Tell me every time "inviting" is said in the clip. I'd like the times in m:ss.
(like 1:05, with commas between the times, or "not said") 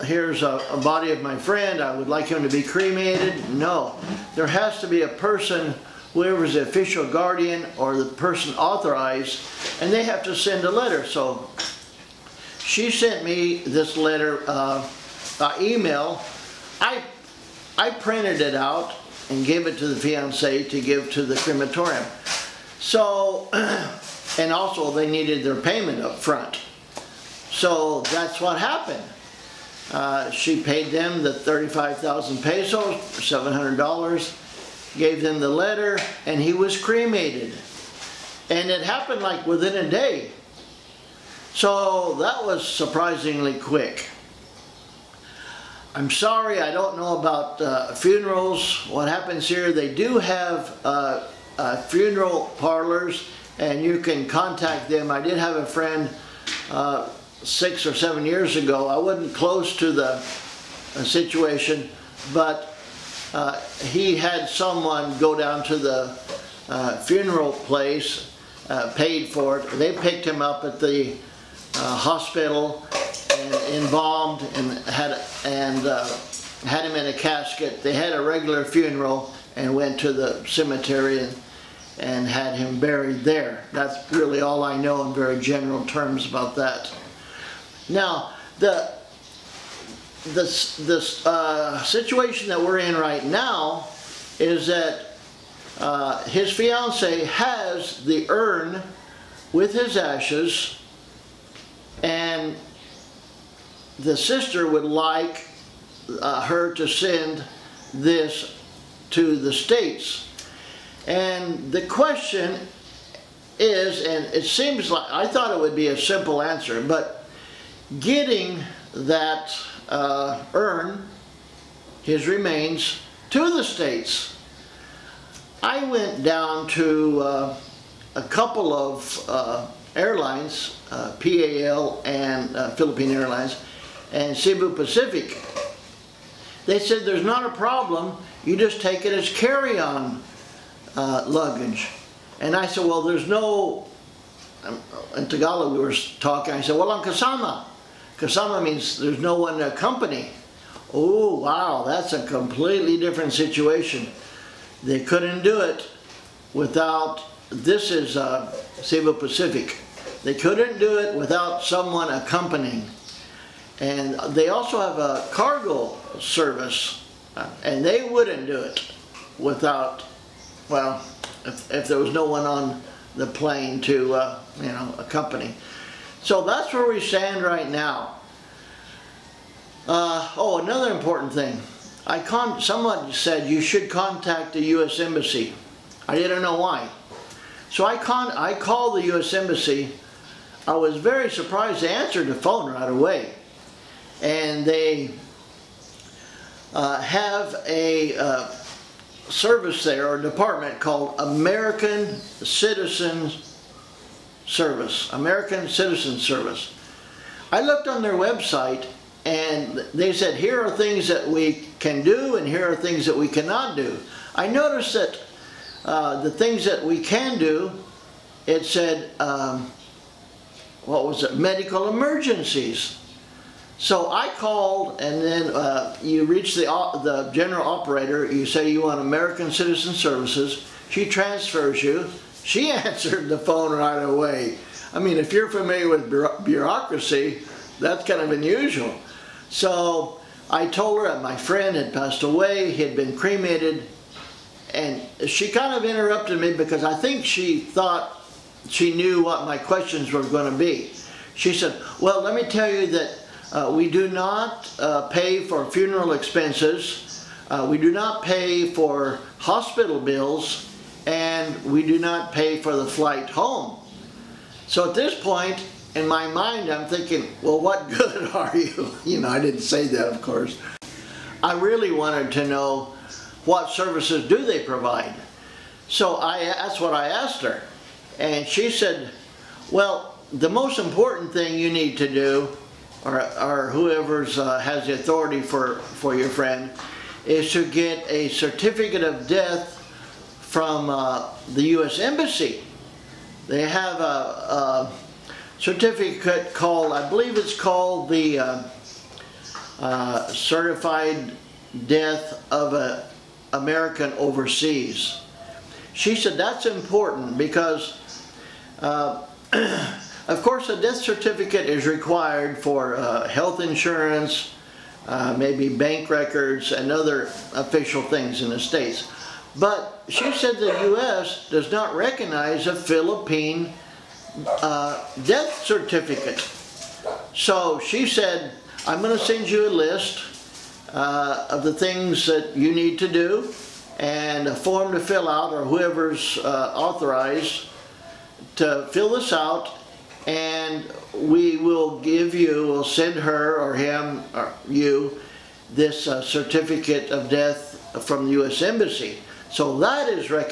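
not said.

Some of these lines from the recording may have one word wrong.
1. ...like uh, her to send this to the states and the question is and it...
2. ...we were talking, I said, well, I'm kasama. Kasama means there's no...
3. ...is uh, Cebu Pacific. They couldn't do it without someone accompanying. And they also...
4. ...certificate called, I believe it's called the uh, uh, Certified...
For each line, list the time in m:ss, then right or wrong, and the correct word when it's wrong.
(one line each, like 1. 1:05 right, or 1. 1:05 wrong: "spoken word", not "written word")
1. 1:44 right
2. 2:25 right
3. 2:37 right
4. 4:55 right.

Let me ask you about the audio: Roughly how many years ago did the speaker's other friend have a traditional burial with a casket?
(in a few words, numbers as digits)
6 or 7.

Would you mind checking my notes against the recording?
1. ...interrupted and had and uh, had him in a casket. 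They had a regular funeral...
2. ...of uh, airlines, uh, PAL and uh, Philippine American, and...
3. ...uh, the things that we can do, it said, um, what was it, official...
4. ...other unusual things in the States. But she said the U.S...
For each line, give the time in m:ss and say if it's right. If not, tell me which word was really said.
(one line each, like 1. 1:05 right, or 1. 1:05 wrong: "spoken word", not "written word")
1. 1:13 wrong: "embalmed", not "interrupted"
2. 2:08 wrong: "Airlines", not "American"
3. 3:35 wrong: "medical", not "official"
4. 5:16 wrong: "official", not "unusual".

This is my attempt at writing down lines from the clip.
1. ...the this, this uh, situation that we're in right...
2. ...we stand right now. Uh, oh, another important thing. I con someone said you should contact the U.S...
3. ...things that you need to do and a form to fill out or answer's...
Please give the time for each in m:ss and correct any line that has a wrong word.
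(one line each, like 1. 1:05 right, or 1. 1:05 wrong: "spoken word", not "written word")
1. 1:28 right
2. 2:56 right
3. 5:31 wrong: "whoever", not "answer".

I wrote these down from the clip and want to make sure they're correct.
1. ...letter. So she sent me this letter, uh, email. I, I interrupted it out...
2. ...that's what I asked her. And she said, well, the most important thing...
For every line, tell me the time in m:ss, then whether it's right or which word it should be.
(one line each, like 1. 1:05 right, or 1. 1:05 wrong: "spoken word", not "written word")
1. 0:10 wrong: "printed", not "interrupted"
2. 4:36 right.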